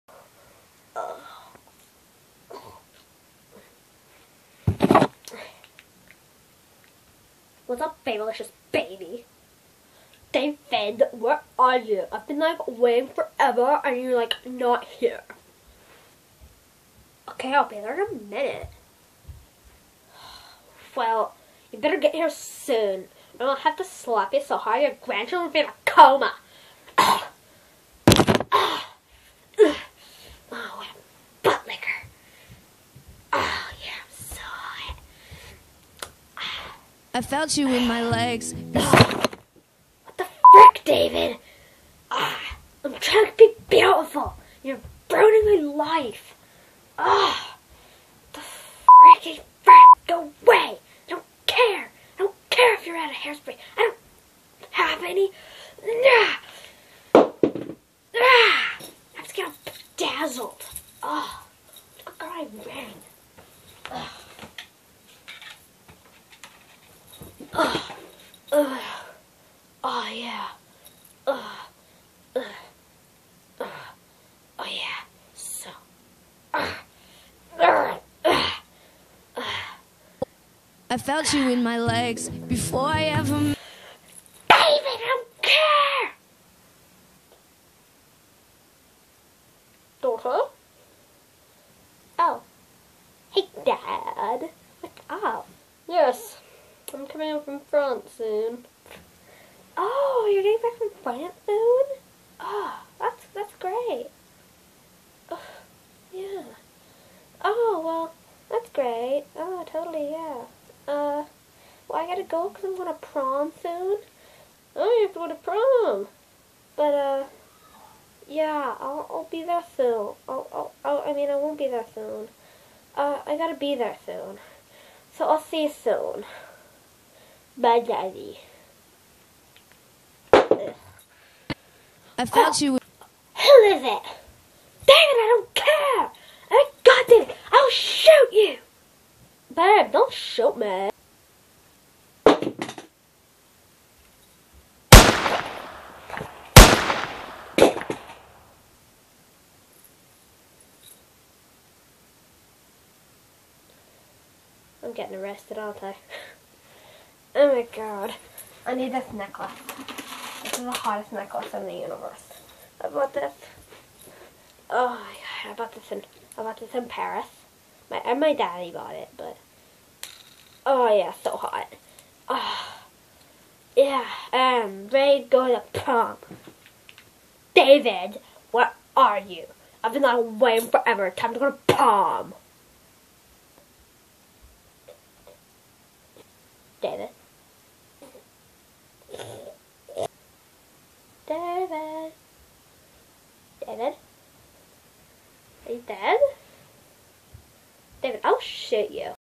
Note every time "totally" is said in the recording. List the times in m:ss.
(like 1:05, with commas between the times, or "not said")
1:49.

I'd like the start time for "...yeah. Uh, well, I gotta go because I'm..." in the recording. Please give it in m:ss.
1:50.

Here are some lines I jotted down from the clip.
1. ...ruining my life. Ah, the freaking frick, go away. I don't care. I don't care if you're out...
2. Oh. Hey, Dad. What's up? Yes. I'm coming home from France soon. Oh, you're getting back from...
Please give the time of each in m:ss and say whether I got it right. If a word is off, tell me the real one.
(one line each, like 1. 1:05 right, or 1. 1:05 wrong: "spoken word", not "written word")
1. 0:45 right
2. 1:32 right.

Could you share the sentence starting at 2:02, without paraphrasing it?
Uh, I gotta be there soon.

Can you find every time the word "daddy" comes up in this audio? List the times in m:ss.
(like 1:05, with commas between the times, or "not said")
2:07, 2:48.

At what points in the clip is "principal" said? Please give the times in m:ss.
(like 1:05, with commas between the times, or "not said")
not said.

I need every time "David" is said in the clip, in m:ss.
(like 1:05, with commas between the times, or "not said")
0:10, 0:40, 1:23, 2:14, 2:57, 3:06, 3:13, 3:18.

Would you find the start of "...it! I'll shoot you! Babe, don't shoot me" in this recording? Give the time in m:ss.
2:17.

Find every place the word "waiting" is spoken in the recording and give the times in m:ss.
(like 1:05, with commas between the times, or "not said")
0:12, 3:00.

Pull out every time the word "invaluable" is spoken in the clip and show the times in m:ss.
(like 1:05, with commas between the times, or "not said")
not said.